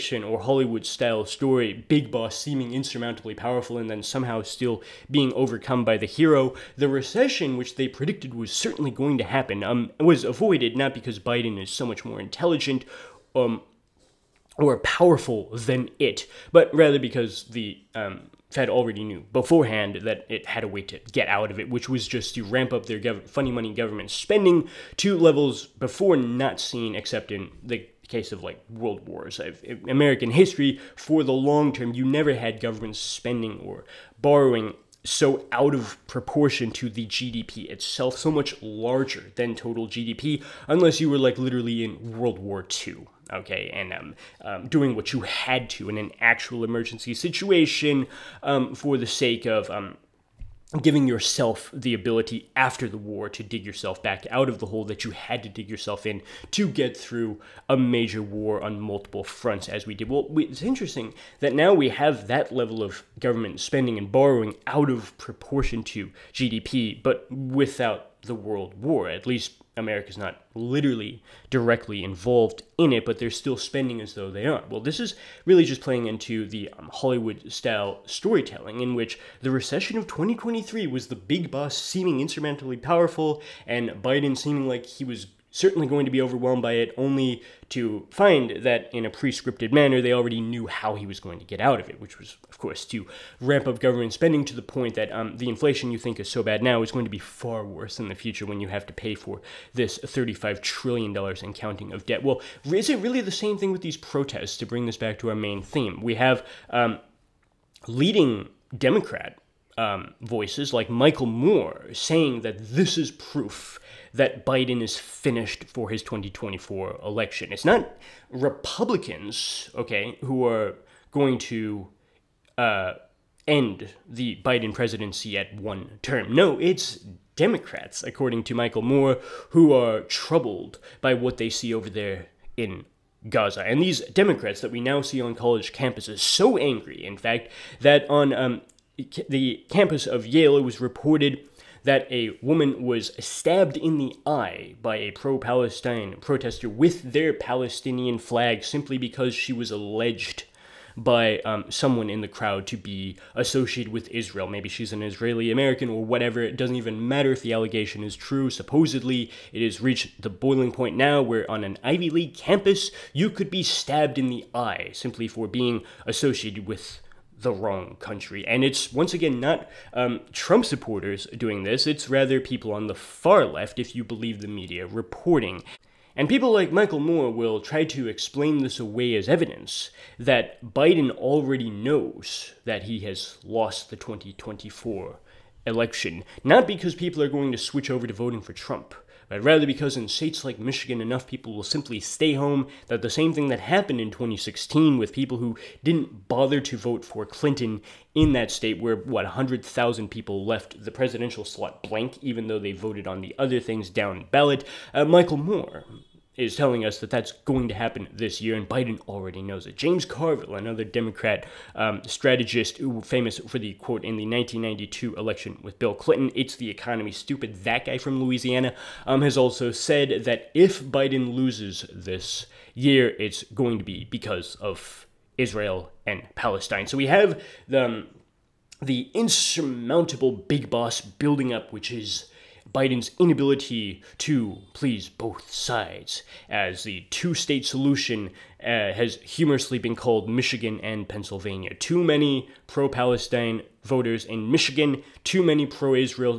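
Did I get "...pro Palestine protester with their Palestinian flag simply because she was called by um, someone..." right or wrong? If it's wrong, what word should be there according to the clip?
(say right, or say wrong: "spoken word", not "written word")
wrong: "alleged", not "called".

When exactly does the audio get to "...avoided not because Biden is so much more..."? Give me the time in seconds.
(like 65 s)
10 s.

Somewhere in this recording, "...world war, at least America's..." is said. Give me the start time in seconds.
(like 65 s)
68 s.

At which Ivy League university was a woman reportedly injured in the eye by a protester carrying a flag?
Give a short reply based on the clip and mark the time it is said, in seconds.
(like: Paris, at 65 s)
Yale, at 140 s.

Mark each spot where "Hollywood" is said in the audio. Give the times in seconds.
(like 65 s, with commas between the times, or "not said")
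0 s, 76 s.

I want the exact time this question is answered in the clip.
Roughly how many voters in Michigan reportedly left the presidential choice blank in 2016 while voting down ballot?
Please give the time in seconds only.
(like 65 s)
199 s.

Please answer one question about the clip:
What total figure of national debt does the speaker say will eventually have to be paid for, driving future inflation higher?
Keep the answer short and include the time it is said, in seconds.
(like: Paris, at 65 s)
$35 trillion, at 99 s.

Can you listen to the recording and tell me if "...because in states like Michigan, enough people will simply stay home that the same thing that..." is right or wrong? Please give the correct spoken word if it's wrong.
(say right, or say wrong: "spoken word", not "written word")
right.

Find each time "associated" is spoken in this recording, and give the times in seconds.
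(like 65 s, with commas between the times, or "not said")
153 s, 166 s.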